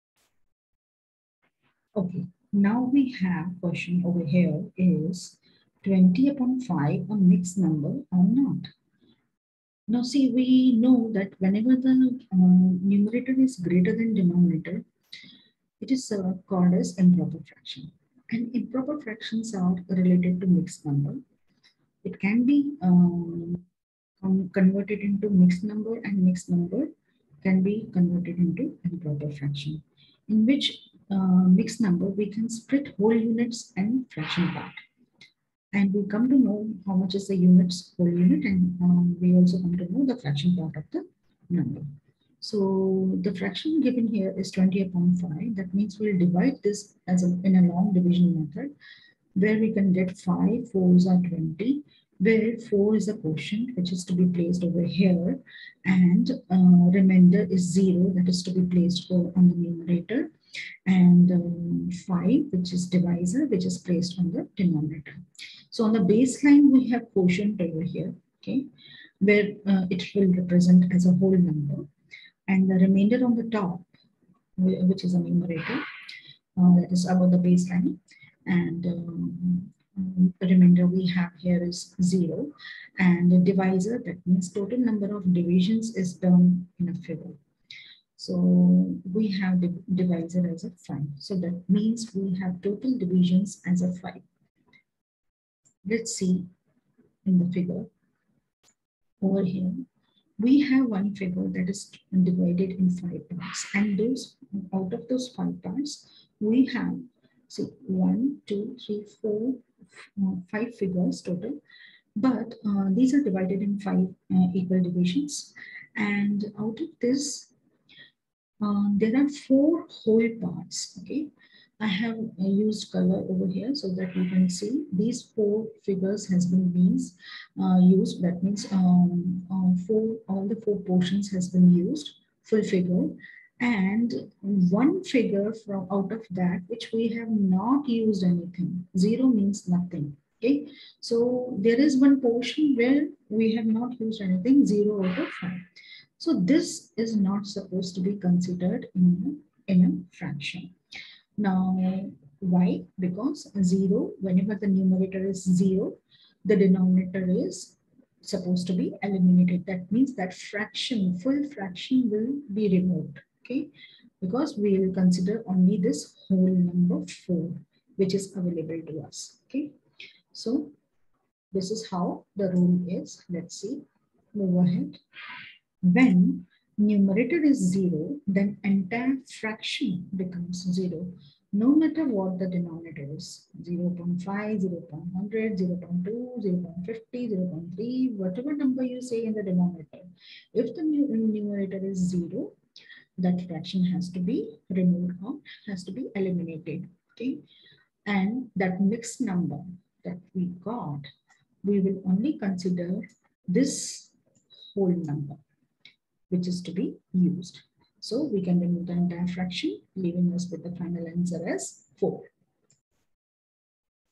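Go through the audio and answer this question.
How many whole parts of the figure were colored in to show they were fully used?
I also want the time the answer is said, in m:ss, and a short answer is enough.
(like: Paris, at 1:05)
4, at 1:59.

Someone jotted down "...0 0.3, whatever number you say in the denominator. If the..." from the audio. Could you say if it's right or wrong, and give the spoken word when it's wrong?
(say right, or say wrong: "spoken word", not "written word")
right.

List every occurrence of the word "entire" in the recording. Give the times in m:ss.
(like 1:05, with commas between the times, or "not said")
2:58, 3:28.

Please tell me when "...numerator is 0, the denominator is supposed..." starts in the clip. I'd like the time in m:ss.
2:34.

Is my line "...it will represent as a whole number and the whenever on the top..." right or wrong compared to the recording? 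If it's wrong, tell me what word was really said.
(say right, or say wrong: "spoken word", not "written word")
wrong: "remainder", not "whenever".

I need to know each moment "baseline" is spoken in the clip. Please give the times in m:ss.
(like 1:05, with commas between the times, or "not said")
1:06, 1:17.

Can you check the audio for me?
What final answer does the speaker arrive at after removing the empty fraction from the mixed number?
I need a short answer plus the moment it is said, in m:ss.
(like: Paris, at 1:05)
4, at 3:30.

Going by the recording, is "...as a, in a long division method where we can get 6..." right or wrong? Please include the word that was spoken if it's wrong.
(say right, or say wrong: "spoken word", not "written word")
wrong: "5", not "6".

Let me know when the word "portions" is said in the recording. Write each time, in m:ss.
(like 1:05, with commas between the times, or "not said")
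2:10, 2:22.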